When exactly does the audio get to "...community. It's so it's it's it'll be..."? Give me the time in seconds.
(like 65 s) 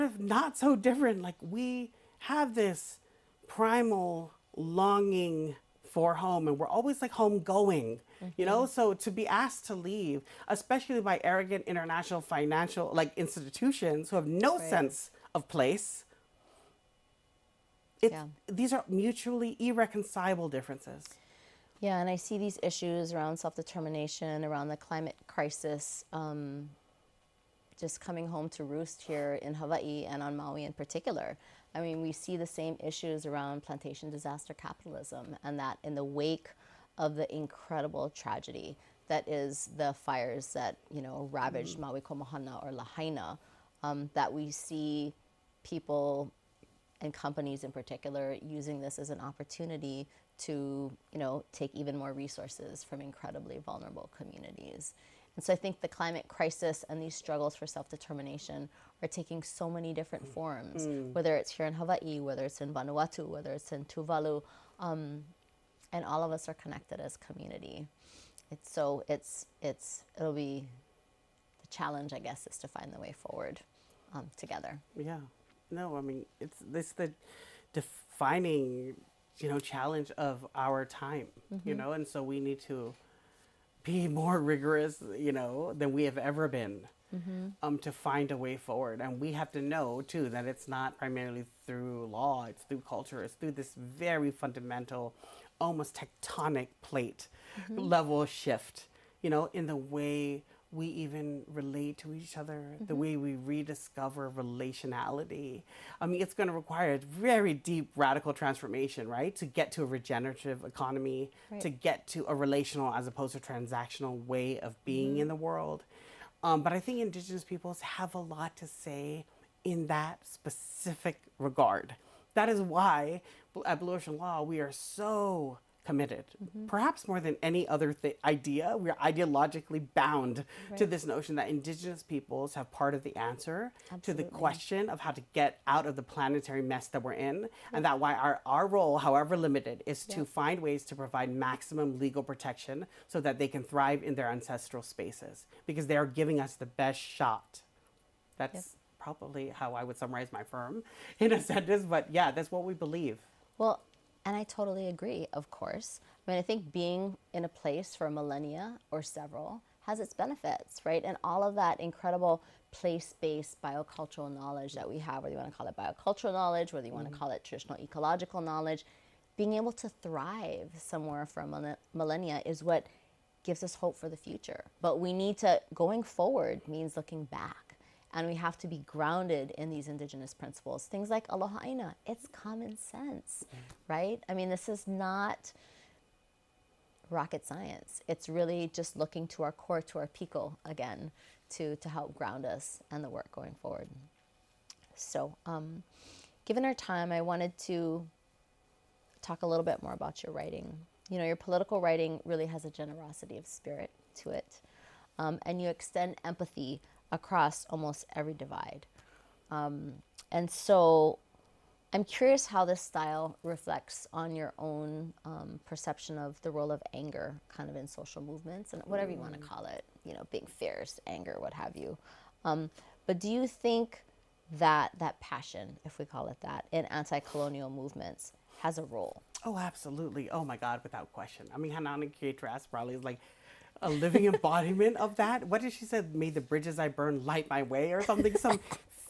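67 s.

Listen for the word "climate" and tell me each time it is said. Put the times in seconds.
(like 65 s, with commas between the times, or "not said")
24 s, 55 s.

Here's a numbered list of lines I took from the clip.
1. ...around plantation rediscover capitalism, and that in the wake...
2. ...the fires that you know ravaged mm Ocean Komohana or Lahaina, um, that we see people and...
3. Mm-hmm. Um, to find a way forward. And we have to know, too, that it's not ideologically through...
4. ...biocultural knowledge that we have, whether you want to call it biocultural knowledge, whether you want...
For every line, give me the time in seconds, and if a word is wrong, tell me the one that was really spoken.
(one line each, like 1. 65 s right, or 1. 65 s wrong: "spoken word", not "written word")
1. 33 s wrong: "disaster", not "rediscover"
2. 39 s wrong: "Maui", not "Ocean"
3. 87 s wrong: "primarily", not "ideologically"
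4. 163 s right.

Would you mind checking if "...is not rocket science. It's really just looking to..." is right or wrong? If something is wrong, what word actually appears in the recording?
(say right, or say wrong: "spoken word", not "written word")
right.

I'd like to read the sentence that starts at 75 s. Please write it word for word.
No, I mean it's this the defining you know challenge of our time, mm-hmm.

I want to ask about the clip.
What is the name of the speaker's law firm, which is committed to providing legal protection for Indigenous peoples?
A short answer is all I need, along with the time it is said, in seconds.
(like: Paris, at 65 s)
Blue Ocean Law, at 123 s.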